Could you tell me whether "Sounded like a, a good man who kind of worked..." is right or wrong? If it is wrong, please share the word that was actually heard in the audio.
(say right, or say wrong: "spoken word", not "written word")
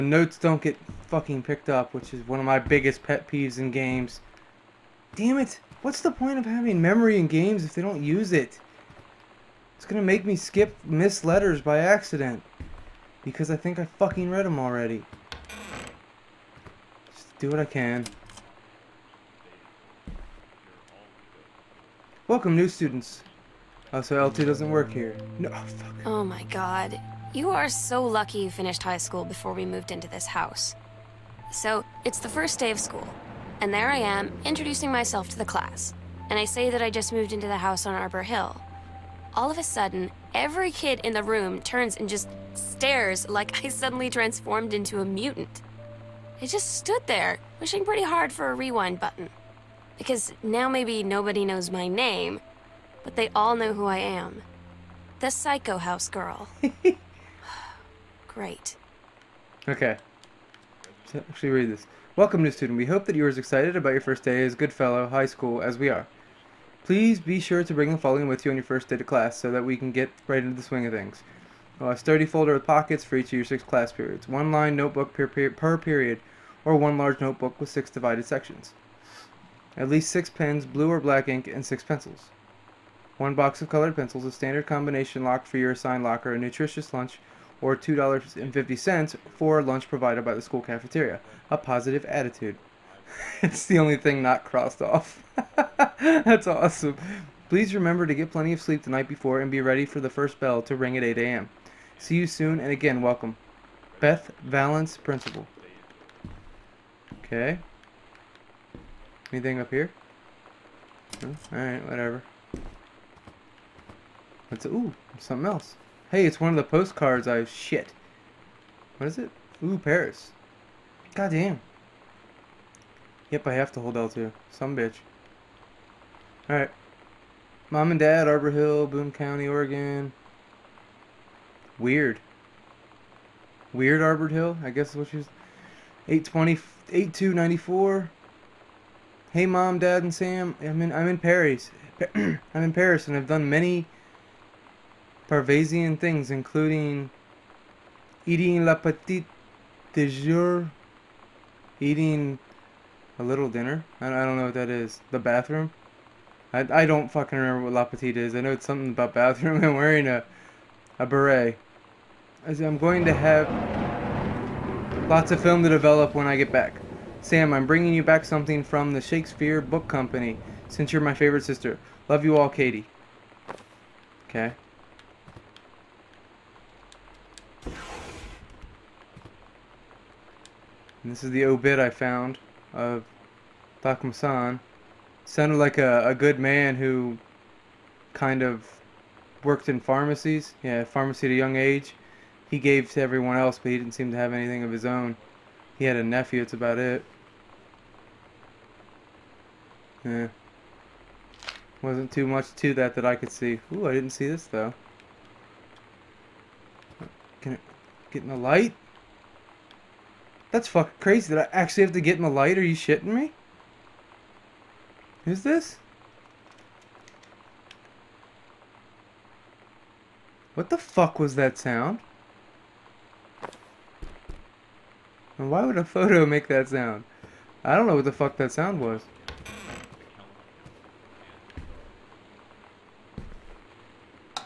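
right.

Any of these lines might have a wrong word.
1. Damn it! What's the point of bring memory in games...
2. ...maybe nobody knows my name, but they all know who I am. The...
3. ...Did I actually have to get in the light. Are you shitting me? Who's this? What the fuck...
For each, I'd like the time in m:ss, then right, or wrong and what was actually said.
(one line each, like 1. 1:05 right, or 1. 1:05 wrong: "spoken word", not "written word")
1. 0:05 wrong: "having", not "bring"
2. 0:50 right
3. 3:31 right.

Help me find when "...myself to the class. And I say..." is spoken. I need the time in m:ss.
0:34.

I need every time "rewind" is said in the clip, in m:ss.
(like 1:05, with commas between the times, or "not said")
0:48.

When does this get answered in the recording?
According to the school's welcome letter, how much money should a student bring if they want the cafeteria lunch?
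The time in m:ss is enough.
1:27.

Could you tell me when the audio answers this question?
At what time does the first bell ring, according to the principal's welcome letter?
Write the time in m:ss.
1:41.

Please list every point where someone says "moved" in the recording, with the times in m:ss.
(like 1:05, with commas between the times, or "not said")
0:29, 0:37.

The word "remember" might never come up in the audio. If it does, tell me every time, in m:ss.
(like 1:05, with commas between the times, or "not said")
1:37, 2:37.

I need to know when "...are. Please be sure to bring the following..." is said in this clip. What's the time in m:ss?
1:05.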